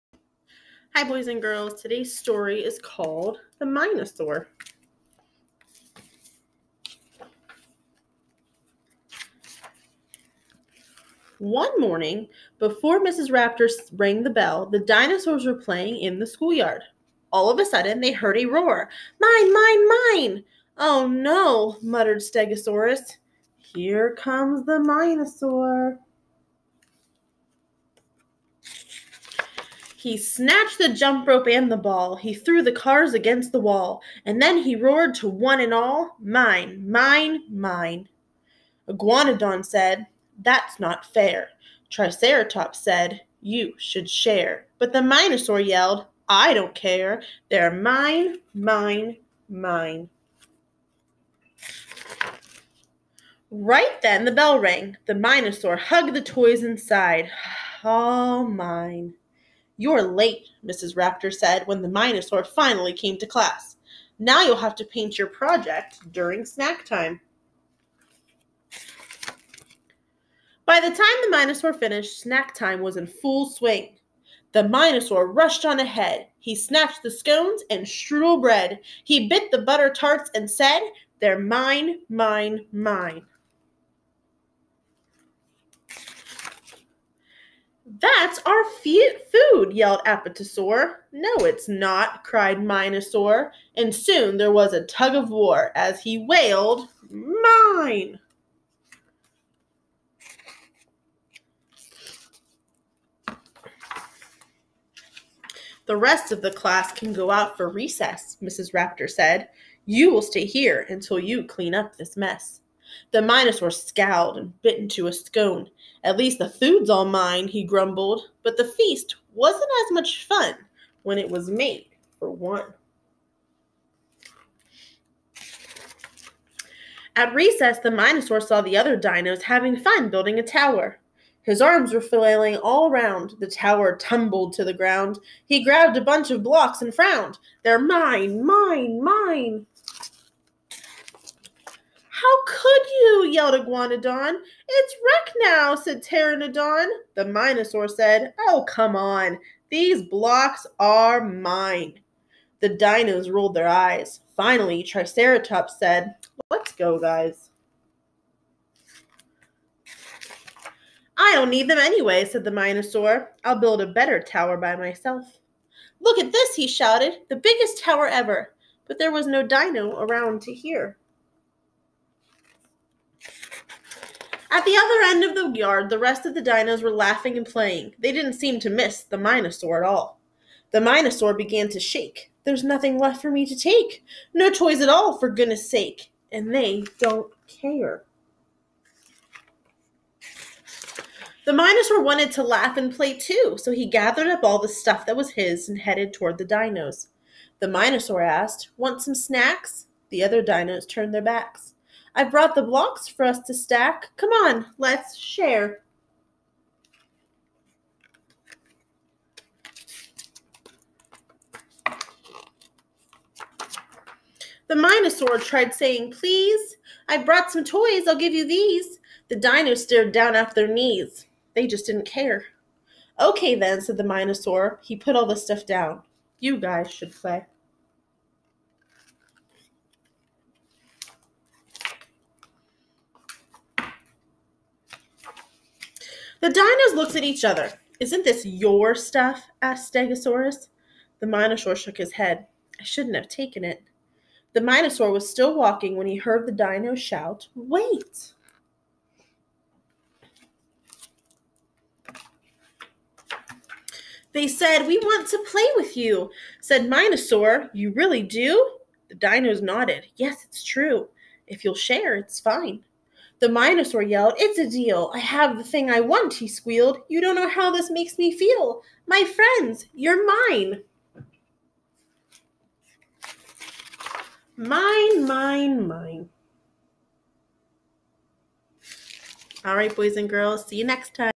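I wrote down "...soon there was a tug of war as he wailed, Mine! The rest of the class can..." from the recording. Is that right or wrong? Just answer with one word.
right.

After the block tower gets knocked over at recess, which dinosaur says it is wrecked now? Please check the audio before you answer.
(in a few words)
Pteranodon.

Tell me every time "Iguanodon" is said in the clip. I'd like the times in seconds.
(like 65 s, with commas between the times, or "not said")
38 s, 143 s.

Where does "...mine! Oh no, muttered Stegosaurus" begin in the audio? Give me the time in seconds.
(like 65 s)
19 s.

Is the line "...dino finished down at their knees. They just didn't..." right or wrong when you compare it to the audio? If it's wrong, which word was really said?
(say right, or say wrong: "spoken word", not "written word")
wrong: "stared", not "finished".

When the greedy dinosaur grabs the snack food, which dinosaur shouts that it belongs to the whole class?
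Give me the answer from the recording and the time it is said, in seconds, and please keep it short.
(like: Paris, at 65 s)
Apatosaur, at 90 s.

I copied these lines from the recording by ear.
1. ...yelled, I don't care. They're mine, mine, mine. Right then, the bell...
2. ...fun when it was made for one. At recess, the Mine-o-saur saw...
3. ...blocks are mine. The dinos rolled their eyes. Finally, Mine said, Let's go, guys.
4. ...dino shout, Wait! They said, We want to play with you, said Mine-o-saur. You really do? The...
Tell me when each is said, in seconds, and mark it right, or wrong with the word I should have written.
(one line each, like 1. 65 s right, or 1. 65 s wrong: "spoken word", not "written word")
1. 45 s right
2. 120 s right
3. 150 s wrong: "Triceratops", not "Mine"
4. 246 s right.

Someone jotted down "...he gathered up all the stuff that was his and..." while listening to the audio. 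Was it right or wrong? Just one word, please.
right.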